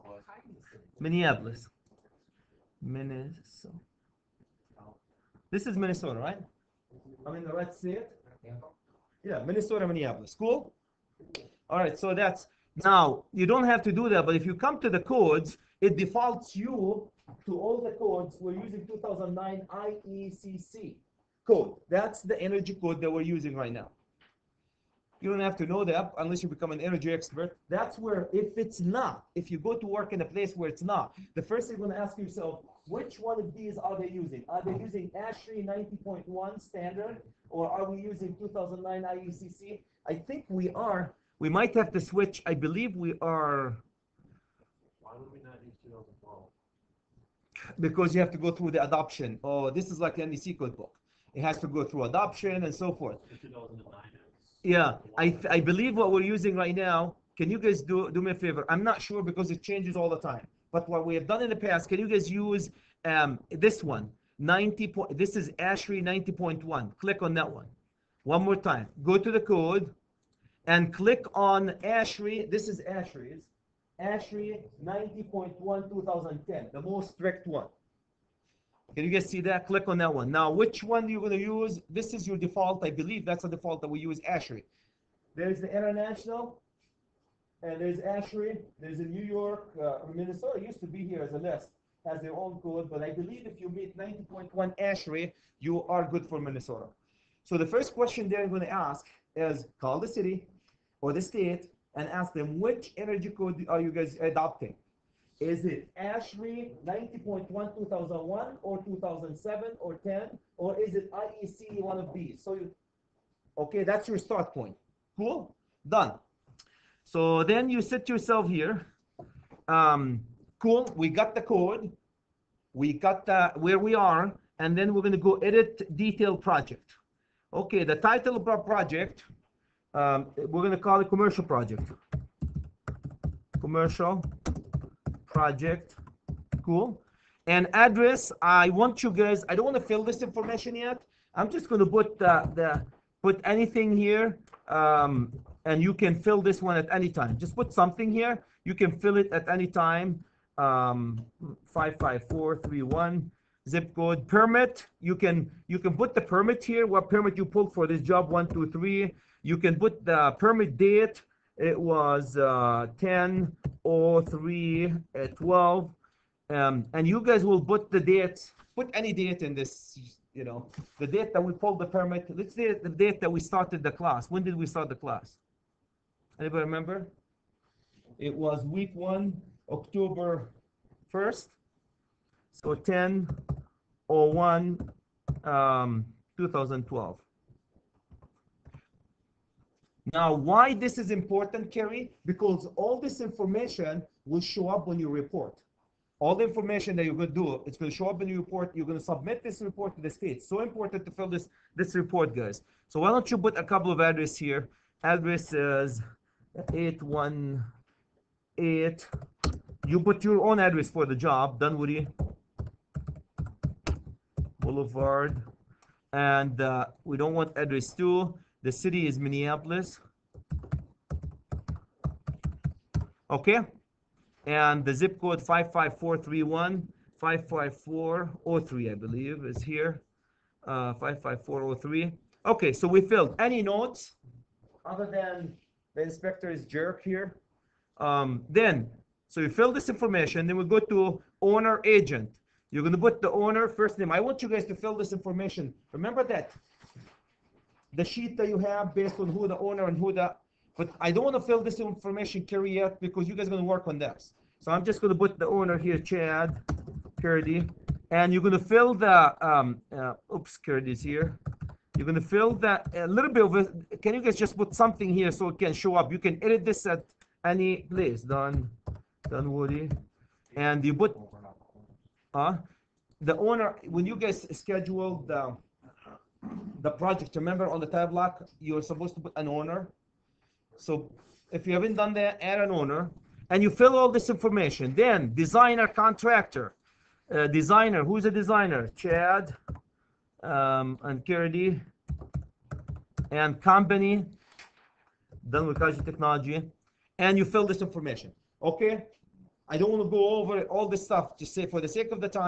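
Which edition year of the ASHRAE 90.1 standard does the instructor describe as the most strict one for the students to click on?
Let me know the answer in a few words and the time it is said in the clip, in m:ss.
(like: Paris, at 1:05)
2010, at 1:15.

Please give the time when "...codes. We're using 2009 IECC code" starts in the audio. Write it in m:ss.
0:17.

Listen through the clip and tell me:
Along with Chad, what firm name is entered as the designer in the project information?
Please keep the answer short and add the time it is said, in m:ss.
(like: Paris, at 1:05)
Kirby and company, at 4:51.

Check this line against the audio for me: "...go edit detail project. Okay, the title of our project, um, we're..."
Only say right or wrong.
right.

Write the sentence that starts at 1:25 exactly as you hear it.
There's the international, and there's ASHRAE.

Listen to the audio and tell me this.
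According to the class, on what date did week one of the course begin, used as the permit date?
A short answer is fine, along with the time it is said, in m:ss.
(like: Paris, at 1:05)
October 1st, at 2:59.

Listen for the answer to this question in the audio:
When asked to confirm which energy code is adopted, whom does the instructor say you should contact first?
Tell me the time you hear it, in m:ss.
1:40.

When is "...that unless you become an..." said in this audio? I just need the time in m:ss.
0:25.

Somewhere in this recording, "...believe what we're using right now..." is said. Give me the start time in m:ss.
0:55.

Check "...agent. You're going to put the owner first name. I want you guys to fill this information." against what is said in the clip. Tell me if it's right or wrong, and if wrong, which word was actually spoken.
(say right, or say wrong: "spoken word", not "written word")
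right.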